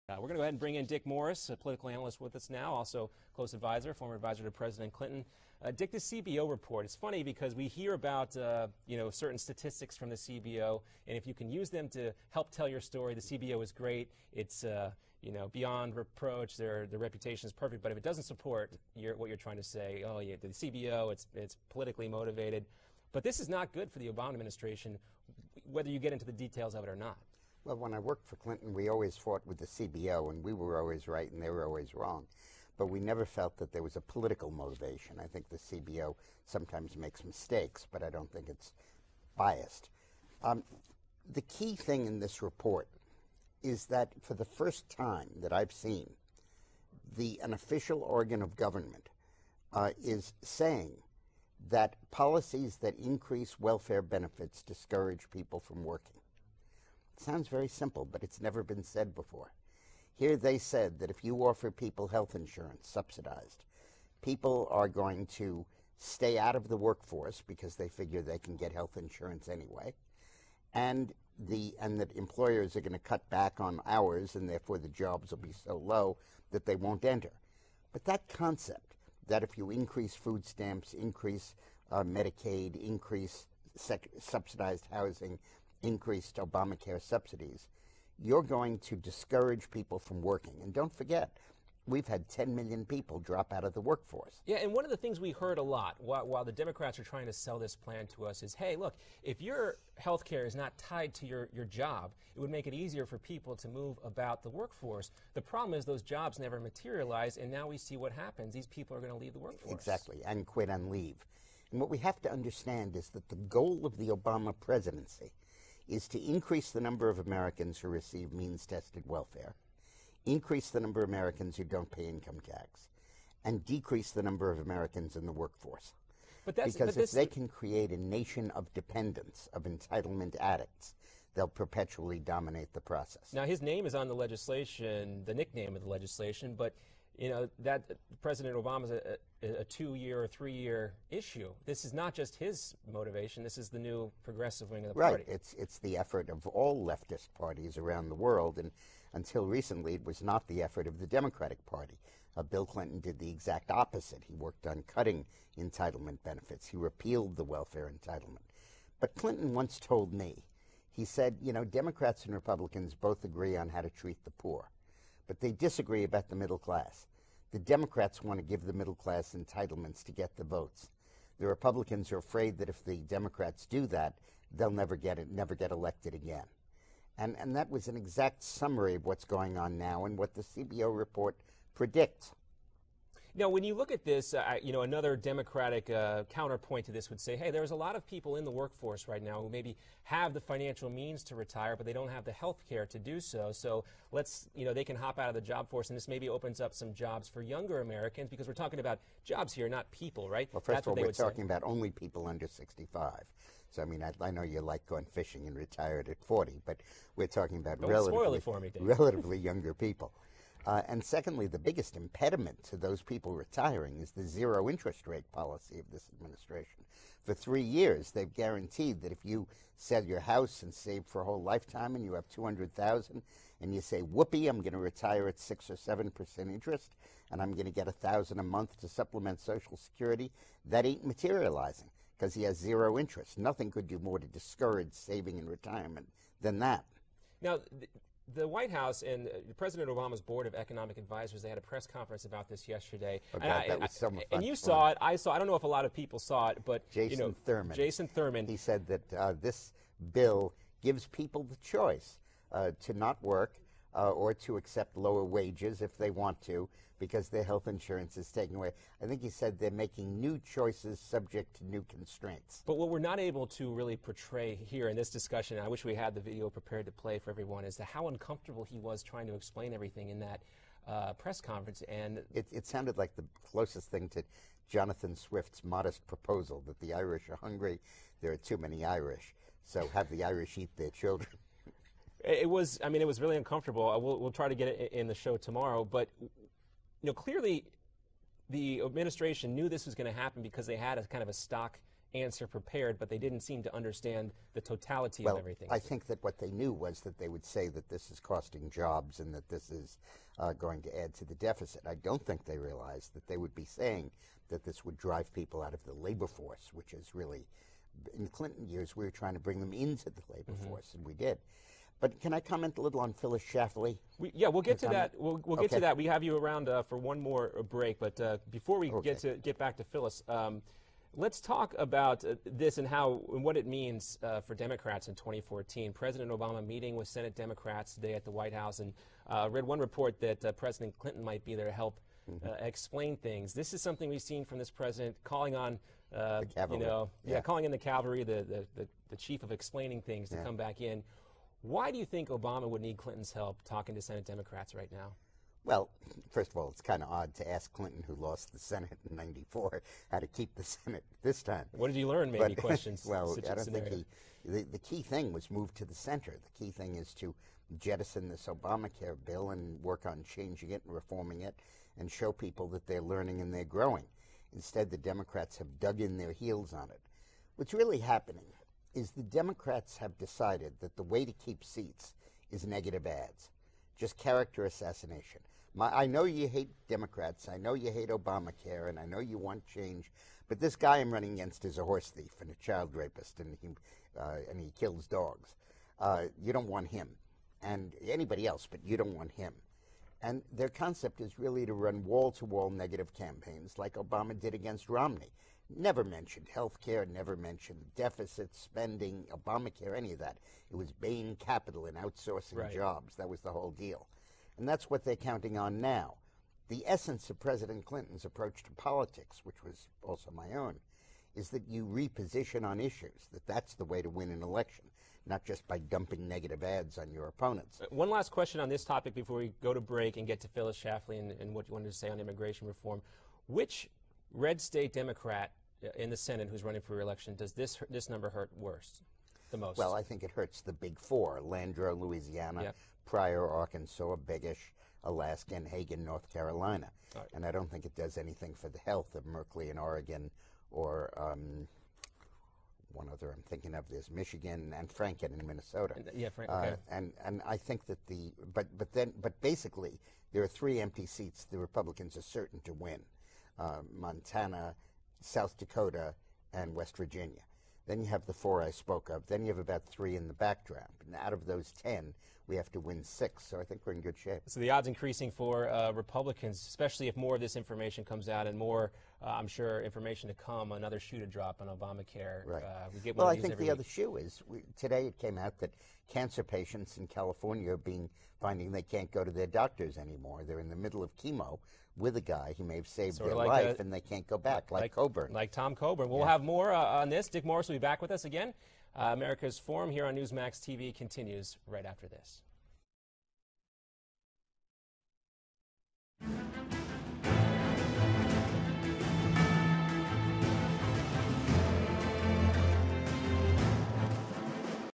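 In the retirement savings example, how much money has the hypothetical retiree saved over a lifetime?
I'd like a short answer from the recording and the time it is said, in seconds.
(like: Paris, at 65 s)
200000, at 222 s.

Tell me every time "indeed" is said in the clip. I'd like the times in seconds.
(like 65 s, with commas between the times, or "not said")
not said.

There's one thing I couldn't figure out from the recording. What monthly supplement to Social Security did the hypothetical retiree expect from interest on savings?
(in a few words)
1000.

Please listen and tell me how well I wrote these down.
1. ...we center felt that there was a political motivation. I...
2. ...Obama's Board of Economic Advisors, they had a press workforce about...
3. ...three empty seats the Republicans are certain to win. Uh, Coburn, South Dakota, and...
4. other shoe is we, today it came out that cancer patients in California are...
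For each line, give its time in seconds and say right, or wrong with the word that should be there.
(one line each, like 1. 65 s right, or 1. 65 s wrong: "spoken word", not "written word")
1. 32 s wrong: "never", not "center"
2. 239 s wrong: "conference", not "workforce"
3. 450 s wrong: "Montana", not "Coburn"
4. 473 s right.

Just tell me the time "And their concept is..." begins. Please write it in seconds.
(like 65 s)
390 s.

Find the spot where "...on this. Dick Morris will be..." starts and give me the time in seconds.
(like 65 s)
486 s.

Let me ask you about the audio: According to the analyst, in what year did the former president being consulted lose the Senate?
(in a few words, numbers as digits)
1994.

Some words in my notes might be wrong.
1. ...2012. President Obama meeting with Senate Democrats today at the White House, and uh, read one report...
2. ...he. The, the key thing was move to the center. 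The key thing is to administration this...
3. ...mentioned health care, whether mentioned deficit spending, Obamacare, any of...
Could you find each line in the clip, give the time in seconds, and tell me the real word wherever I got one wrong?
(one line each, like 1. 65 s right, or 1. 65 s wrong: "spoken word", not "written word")
1. 325 s wrong: "2014", not "2012"
2. 354 s wrong: "jettison", not "administration"
3. 396 s wrong: "never", not "whether".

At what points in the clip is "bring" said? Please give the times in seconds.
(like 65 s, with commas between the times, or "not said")
0 s, 309 s.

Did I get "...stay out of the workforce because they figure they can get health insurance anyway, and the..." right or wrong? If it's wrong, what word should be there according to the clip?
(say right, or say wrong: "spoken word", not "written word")
right.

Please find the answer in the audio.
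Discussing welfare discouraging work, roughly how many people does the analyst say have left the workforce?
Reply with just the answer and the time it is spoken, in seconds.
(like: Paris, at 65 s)
10 million, at 92 s.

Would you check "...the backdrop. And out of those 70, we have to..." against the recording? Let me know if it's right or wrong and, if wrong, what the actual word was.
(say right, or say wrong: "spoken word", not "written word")
wrong: "10", not "70".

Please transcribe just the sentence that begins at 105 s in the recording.
The problem is those jobs never materialize, and now we see what happens.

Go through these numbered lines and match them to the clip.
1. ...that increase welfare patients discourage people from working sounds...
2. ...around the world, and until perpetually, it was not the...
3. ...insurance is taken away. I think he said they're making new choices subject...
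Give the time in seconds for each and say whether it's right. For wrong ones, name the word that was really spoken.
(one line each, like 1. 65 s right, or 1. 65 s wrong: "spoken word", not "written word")
1. 52 s wrong: "benefits", not "patients"
2. 147 s wrong: "recently", not "perpetually"
3. 257 s right.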